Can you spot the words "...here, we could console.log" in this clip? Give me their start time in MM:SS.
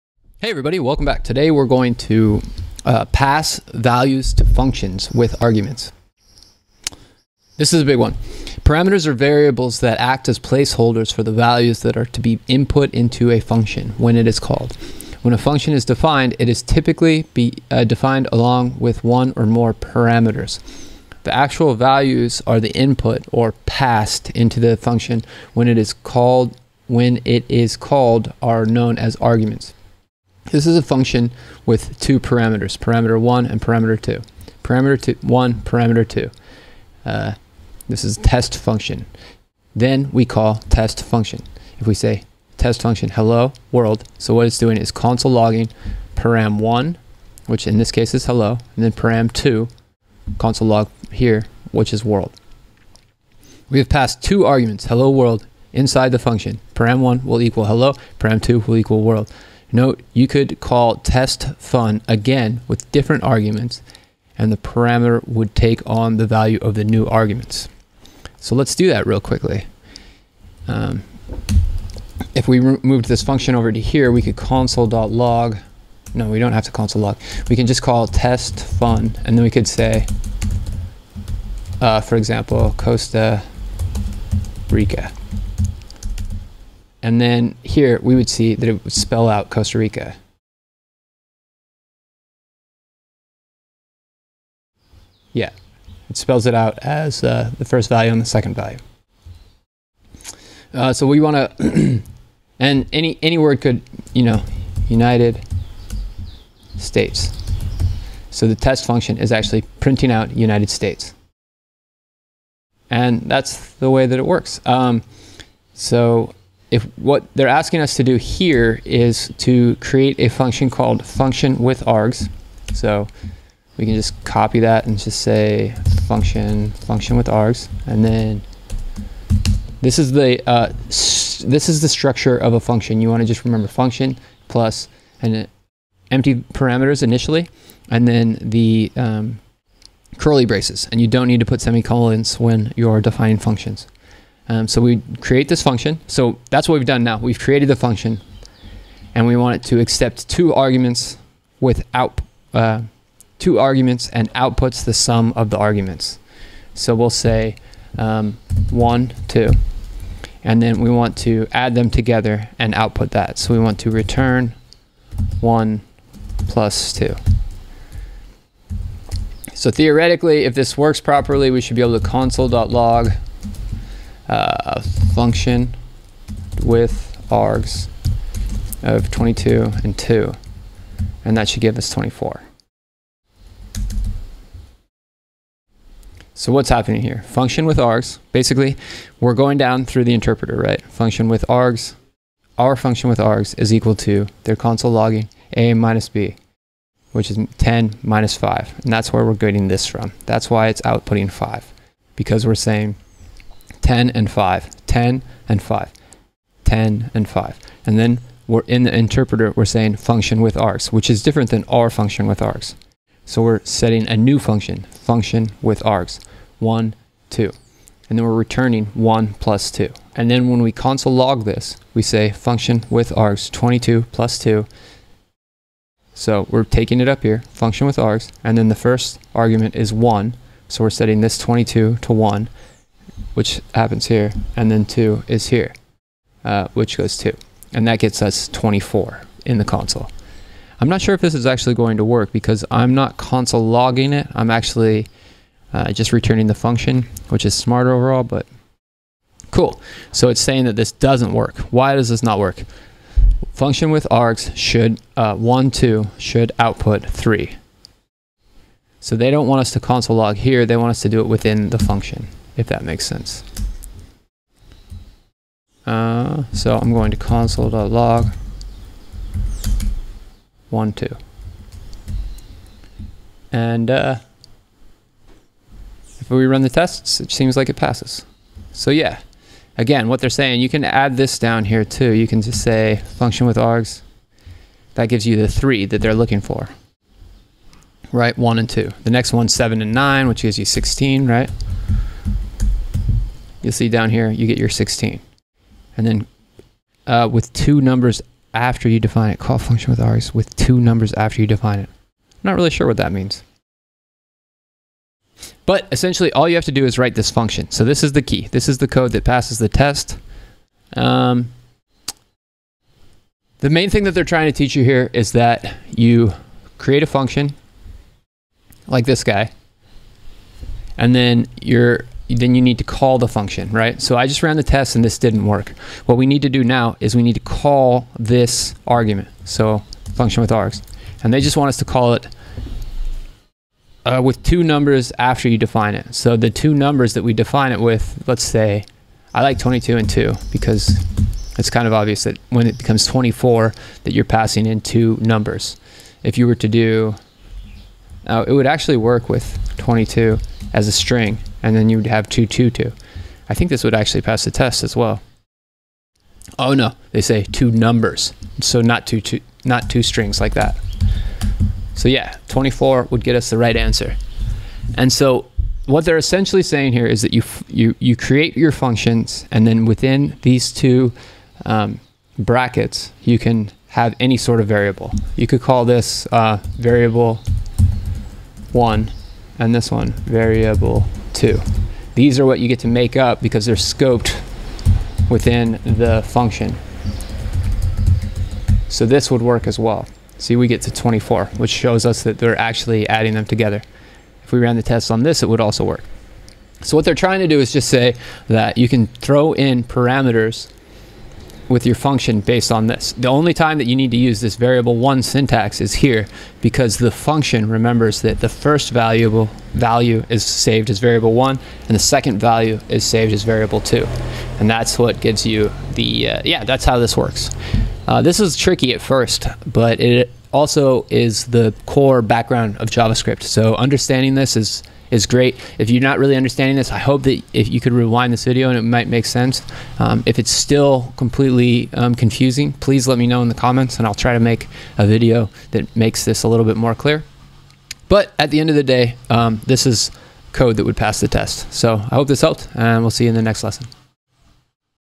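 01:13.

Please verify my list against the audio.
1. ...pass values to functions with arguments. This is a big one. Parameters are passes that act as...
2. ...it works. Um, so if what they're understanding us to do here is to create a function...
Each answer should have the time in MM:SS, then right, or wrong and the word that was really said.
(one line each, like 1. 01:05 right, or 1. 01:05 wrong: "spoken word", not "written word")
1. 00:03 wrong: "variables", not "passes"
2. 01:54 wrong: "asking", not "understanding".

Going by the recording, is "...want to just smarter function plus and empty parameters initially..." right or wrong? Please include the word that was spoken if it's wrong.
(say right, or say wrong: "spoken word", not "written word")
wrong: "remember", not "smarter".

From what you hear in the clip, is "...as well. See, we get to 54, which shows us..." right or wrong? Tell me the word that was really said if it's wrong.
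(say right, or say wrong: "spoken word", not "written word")
wrong: "24", not "54".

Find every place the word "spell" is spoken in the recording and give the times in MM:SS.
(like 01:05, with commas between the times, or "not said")
01:28, 01:36.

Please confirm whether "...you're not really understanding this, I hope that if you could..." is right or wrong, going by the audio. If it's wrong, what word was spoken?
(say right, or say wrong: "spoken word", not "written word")
right.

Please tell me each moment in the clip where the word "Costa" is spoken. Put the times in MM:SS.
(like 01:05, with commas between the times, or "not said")
01:22, 01:29.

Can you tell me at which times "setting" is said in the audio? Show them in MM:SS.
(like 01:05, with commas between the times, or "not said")
03:33, 03:50.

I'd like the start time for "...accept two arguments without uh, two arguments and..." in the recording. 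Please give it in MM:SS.
02:29.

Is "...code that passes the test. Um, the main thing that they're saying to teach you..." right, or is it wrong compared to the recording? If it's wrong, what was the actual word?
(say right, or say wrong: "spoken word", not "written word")
wrong: "trying", not "saying".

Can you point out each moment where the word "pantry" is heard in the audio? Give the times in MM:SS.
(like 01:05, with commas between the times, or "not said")
not said.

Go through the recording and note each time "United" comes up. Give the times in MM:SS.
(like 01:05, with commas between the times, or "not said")
01:44, 01:50.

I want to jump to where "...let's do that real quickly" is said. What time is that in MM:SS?
01:08.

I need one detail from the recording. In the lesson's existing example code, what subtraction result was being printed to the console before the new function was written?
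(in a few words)
5.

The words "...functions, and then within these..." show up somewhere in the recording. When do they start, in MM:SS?
06:08.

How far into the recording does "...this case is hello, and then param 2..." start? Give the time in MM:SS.
00:47.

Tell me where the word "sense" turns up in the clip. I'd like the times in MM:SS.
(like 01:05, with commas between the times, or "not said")
04:23, 07:09.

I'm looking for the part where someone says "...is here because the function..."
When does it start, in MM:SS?
06:45.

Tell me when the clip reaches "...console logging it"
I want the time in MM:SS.
04:03.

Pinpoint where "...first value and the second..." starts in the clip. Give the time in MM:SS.
01:37.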